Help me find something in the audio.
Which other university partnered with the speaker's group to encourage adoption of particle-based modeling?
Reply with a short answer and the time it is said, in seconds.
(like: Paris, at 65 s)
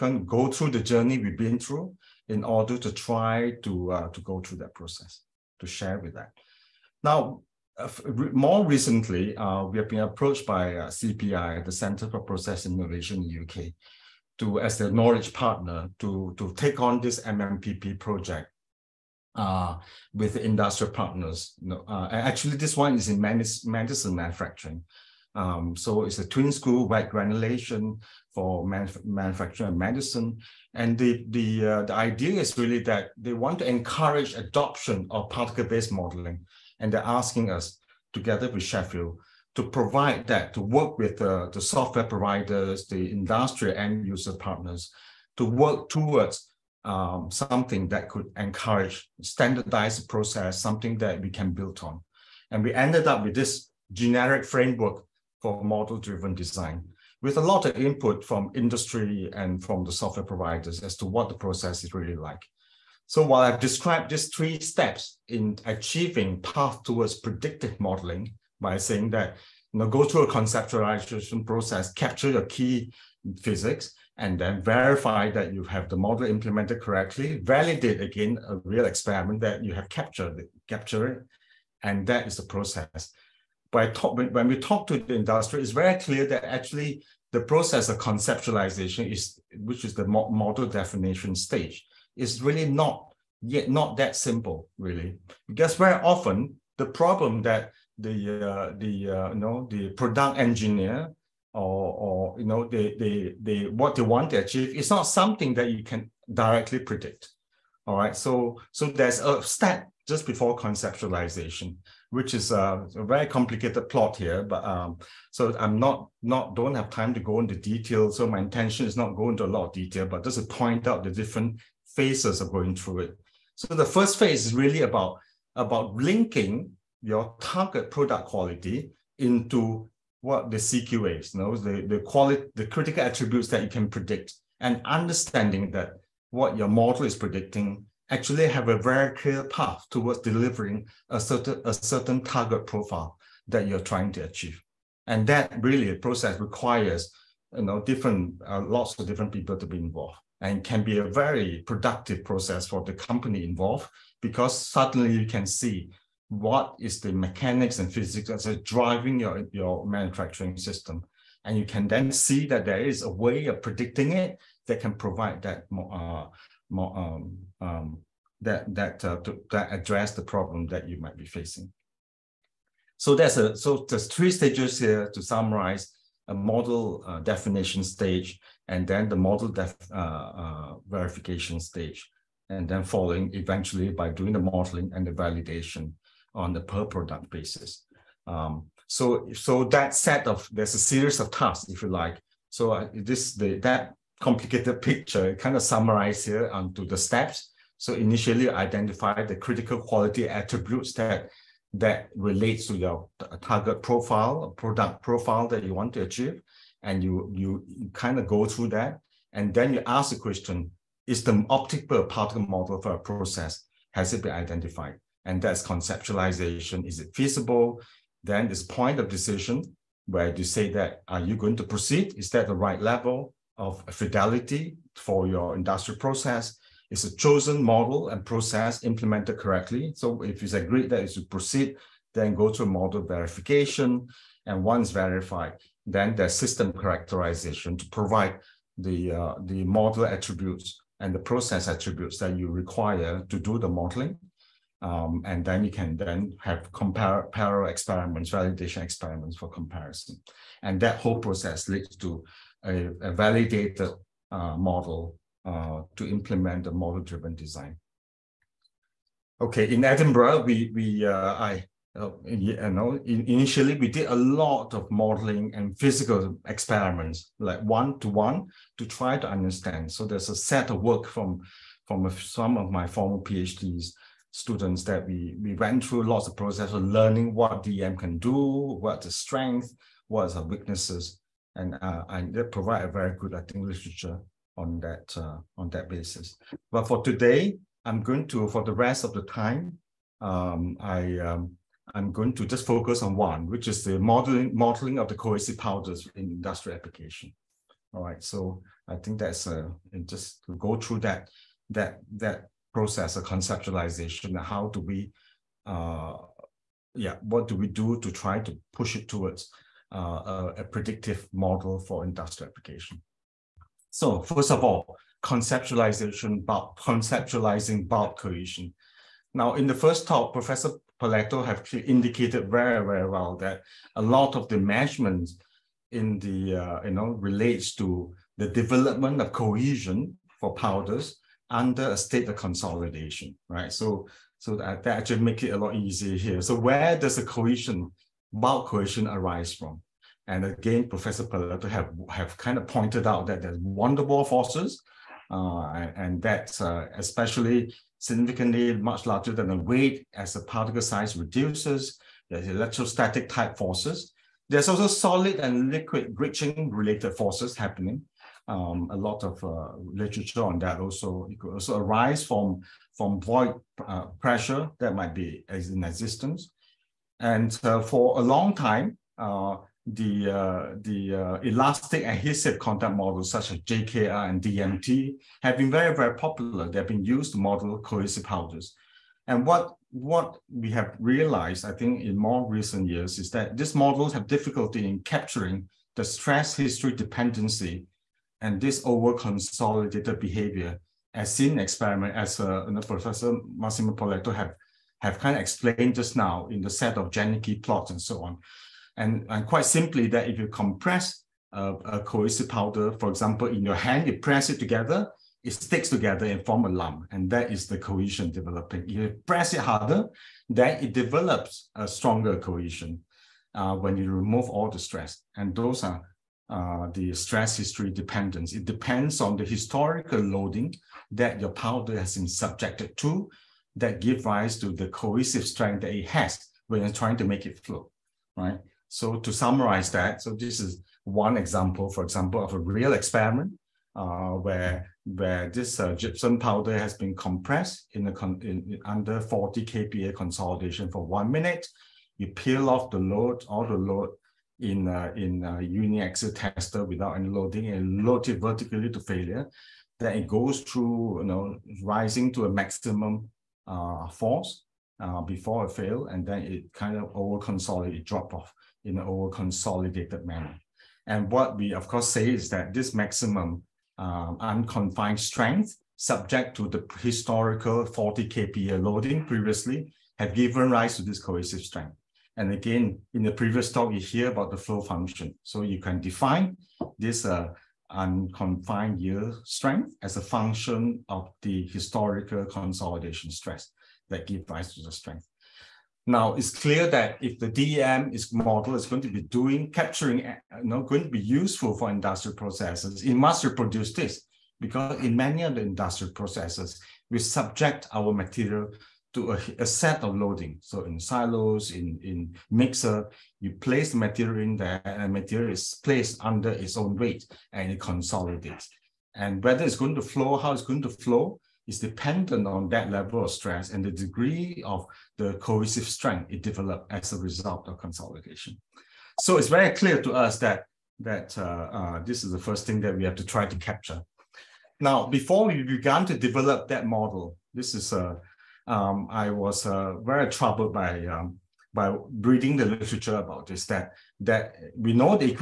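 Sheffield, at 38 s.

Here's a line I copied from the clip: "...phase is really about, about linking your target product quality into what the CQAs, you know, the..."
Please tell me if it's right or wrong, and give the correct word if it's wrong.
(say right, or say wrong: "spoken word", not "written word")
right.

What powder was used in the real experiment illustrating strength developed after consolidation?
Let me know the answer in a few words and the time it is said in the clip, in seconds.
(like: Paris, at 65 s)
Gypsum, at 435 s.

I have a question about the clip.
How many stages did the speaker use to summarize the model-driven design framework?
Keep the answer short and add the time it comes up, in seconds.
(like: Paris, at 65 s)
3, at 174 s.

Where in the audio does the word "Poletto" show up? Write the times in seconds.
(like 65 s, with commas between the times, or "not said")
320 s, 341 s, 393 s.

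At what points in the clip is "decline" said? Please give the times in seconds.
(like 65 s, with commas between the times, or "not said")
not said.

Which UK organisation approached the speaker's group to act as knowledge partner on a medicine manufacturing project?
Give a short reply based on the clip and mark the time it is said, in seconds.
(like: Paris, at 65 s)
Center for Process Innovation, at 11 s.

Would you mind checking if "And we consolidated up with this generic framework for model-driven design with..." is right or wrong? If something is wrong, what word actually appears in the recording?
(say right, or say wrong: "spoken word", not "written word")
wrong: "ended", not "consolidated".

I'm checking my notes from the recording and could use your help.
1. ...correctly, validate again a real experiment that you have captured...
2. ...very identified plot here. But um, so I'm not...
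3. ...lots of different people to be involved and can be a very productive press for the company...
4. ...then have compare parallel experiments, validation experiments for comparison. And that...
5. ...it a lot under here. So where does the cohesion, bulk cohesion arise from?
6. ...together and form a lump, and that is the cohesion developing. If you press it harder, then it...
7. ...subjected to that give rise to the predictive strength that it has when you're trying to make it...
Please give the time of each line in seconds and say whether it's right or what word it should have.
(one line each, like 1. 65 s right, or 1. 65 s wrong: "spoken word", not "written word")
1. 76 s right
2. 113 s wrong: "complicated", not "identified"
3. 148 s wrong: "process", not "press"
4. 245 s right
5. 335 s wrong: "easier", not "under"
6. 405 s right
7. 422 s wrong: "cohesive", not "predictive".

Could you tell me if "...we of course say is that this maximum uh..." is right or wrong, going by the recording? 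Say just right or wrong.
right.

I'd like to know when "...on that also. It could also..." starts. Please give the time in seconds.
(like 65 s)
360 s.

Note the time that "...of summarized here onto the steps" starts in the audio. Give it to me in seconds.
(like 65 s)
195 s.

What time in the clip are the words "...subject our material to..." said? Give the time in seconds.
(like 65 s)
497 s.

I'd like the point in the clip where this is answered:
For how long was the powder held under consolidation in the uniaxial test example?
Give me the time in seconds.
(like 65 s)
441 s.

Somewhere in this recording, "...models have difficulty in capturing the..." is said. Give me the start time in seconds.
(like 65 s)
383 s.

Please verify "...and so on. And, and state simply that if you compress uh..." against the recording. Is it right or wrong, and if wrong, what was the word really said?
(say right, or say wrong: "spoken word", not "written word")
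wrong: "quite", not "state".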